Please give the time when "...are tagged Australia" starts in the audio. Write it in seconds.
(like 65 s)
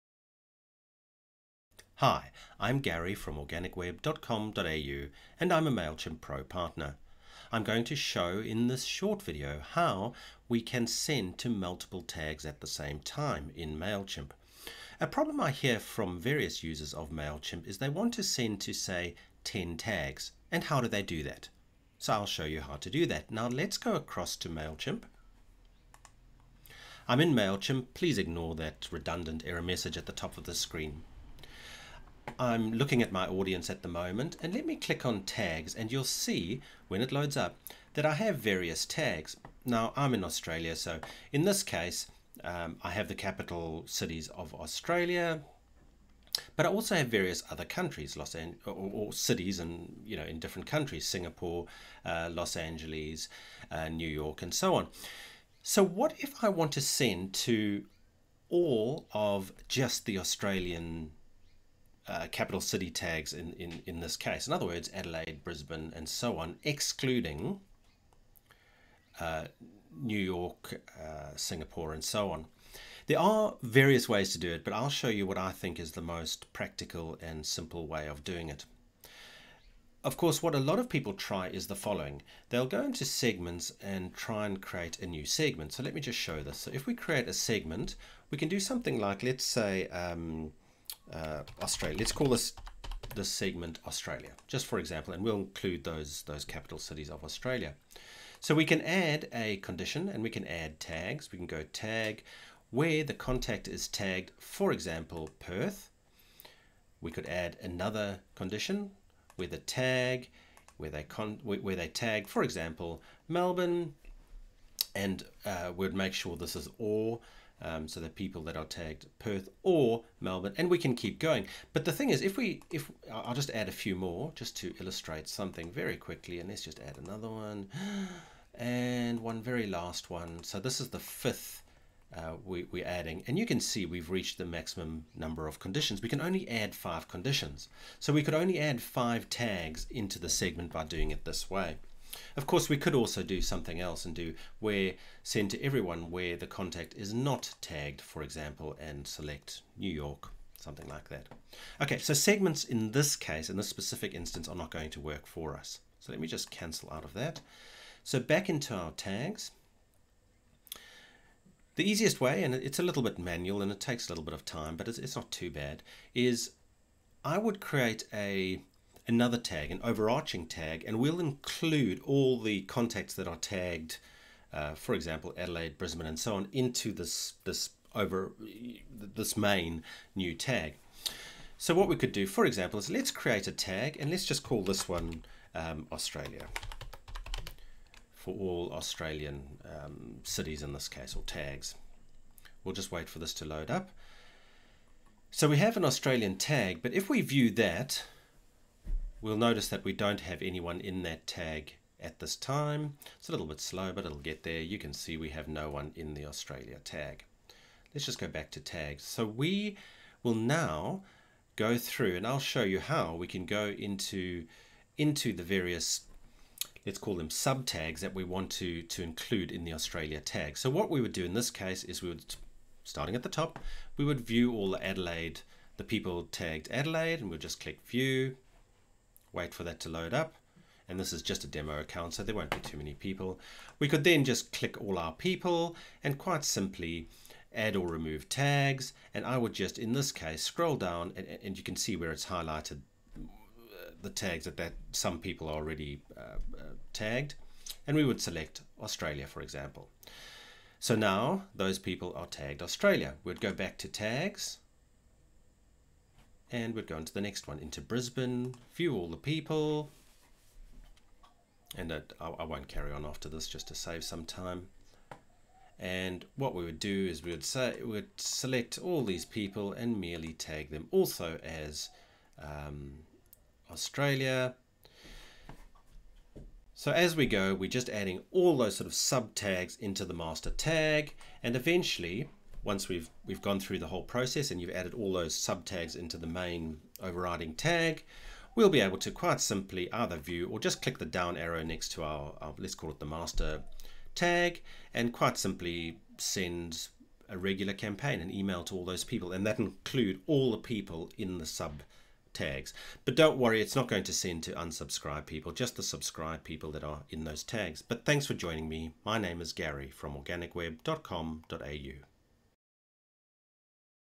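252 s.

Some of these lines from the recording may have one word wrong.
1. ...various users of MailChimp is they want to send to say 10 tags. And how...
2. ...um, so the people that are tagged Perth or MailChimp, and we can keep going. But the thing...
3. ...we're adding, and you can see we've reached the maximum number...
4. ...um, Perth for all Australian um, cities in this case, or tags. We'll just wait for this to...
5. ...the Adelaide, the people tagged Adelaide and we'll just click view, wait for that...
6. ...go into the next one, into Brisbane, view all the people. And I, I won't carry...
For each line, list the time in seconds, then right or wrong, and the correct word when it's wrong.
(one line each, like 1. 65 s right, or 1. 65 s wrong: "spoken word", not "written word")
1. 16 s right
2. 117 s wrong: "Melbourne", not "MailChimp"
3. 132 s right
4. 185 s wrong: "Australia", not "Perth"
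5. 224 s right
6. 256 s right.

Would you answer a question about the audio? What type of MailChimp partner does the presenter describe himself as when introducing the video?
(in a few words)
Pro partner.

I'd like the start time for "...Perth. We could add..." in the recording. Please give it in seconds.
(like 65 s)
105 s.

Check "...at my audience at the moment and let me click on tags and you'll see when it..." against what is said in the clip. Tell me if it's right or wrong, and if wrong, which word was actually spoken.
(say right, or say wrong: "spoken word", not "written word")
right.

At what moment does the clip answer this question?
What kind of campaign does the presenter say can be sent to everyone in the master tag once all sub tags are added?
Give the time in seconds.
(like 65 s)
297 s.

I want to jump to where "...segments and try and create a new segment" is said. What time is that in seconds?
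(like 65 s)
83 s.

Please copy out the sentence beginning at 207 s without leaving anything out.
Let's just go back to tags.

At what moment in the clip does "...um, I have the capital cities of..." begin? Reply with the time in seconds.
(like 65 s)
42 s.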